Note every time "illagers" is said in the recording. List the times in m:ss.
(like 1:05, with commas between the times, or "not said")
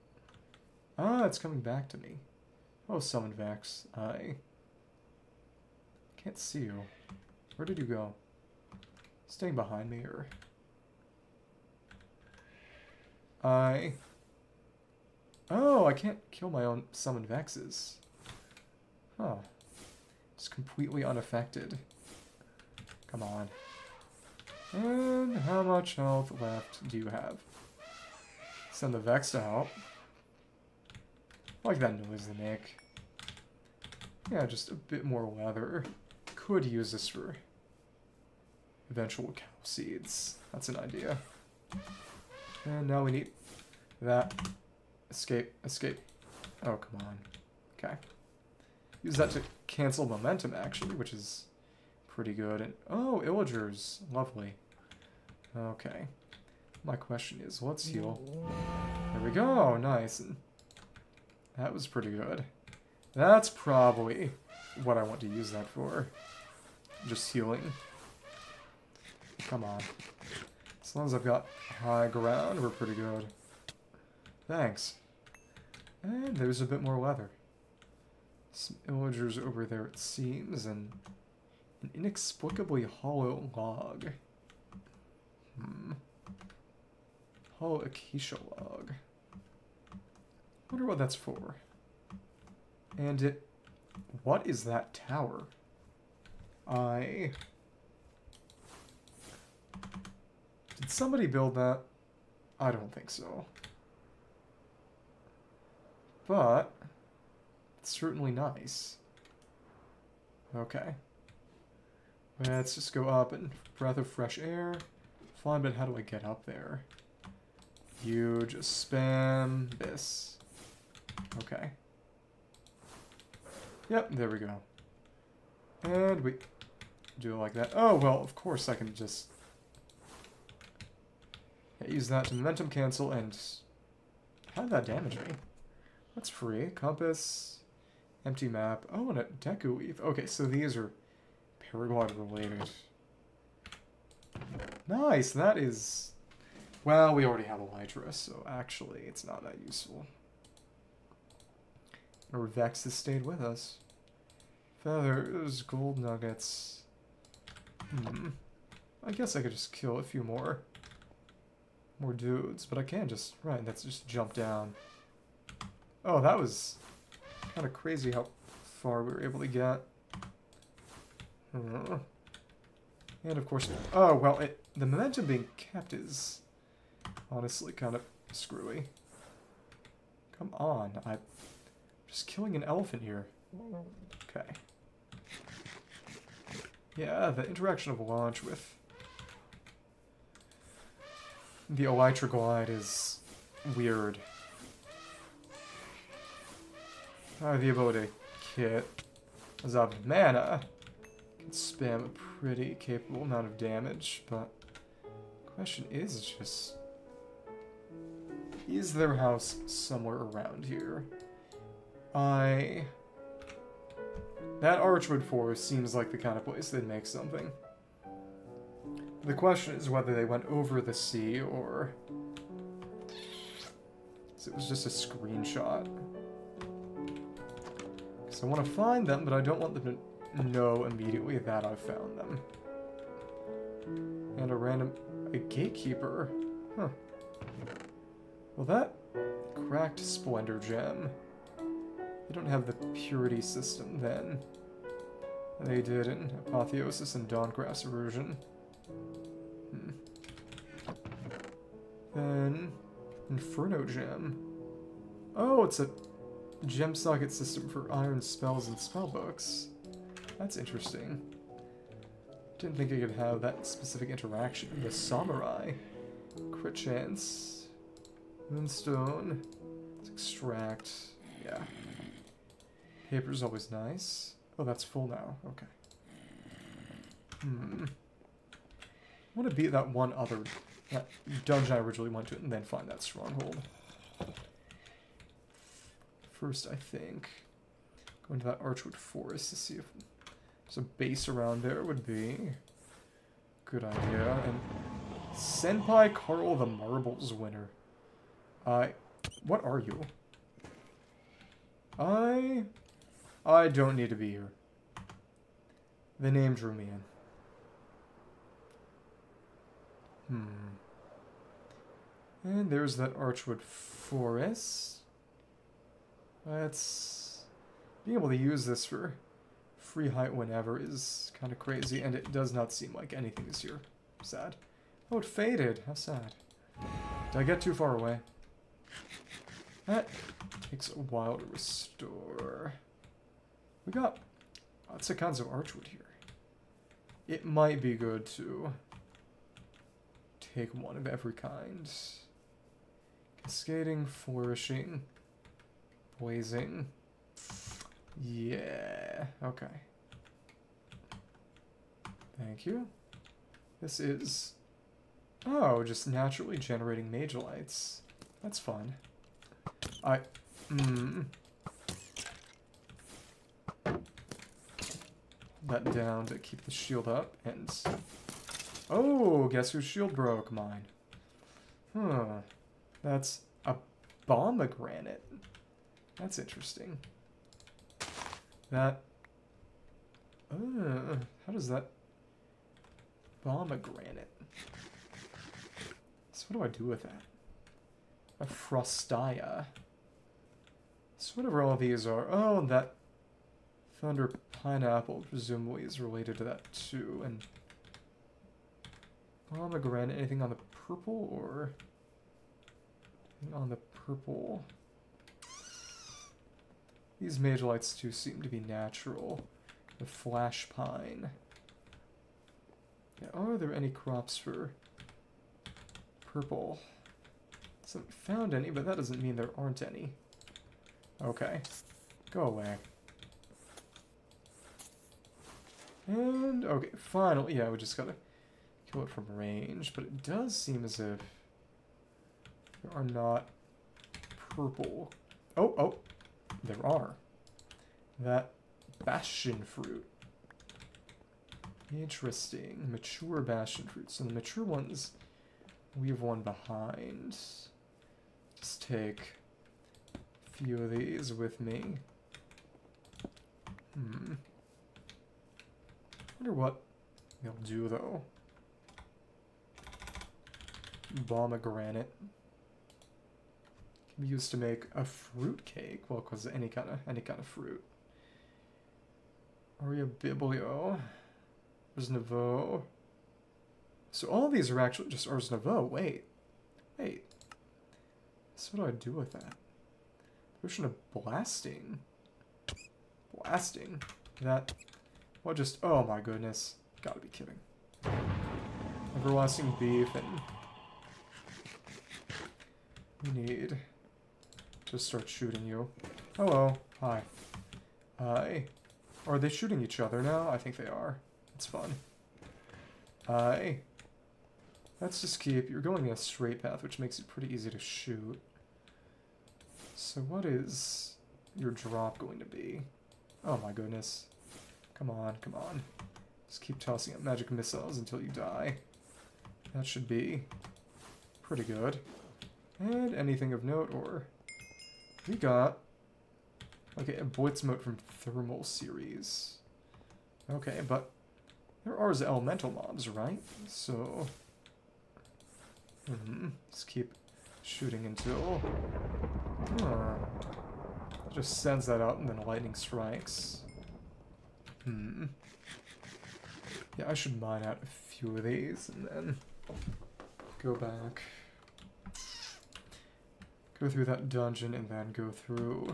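0:53, 1:18.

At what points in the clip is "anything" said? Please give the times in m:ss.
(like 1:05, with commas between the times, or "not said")
5:23, 6:40, 8:43.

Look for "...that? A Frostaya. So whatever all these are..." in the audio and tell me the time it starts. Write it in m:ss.
6:27.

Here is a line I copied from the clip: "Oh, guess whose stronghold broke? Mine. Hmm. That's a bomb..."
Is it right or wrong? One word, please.
wrong.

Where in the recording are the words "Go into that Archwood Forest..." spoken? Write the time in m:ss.
4:48.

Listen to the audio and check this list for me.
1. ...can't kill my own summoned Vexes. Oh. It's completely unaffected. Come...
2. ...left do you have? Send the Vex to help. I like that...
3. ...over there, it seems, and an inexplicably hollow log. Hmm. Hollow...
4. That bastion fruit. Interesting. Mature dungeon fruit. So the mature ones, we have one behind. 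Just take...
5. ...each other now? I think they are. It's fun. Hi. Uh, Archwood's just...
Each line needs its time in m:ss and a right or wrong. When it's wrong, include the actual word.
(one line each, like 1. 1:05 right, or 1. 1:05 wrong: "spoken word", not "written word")
1. 0:15 right
2. 0:26 right
3. 1:19 right
4. 7:18 wrong: "bastion", not "dungeon"
5. 8:19 wrong: "Let", not "Archwood".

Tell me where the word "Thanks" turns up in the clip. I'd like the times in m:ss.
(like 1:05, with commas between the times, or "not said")
1:14, 5:52.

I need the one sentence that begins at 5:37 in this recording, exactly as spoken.
It might be good to take one of every kind.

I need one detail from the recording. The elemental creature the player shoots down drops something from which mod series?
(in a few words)
Thermal Series.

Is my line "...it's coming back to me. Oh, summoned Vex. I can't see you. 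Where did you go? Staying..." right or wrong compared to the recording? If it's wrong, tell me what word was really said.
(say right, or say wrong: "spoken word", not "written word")
right.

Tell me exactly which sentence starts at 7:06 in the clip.
And, okay, finally, yeah, we just gotta kill it from range, but it does seem as if there are not purple.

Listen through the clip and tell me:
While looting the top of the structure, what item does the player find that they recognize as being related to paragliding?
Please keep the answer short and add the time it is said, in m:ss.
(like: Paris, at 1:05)
Deku Leaf, at 2:19.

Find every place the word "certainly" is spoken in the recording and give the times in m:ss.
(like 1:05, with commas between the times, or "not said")
1:47.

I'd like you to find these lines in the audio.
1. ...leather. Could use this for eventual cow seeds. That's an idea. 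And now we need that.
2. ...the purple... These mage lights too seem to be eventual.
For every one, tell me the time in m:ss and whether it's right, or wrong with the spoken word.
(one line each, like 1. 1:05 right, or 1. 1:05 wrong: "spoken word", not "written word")
1. 0:35 right
2. 6:43 wrong: "natural", not "eventual".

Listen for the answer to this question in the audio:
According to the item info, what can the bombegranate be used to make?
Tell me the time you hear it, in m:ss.
7:45.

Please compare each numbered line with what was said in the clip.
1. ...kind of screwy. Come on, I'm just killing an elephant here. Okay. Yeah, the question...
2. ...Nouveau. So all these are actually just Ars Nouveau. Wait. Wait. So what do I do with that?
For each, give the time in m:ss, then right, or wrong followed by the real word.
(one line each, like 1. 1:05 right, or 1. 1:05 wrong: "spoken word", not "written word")
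1. 2:57 wrong: "interaction", not "question"
2. 7:52 right.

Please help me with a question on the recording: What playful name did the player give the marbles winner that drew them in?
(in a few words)
Senpai Carl.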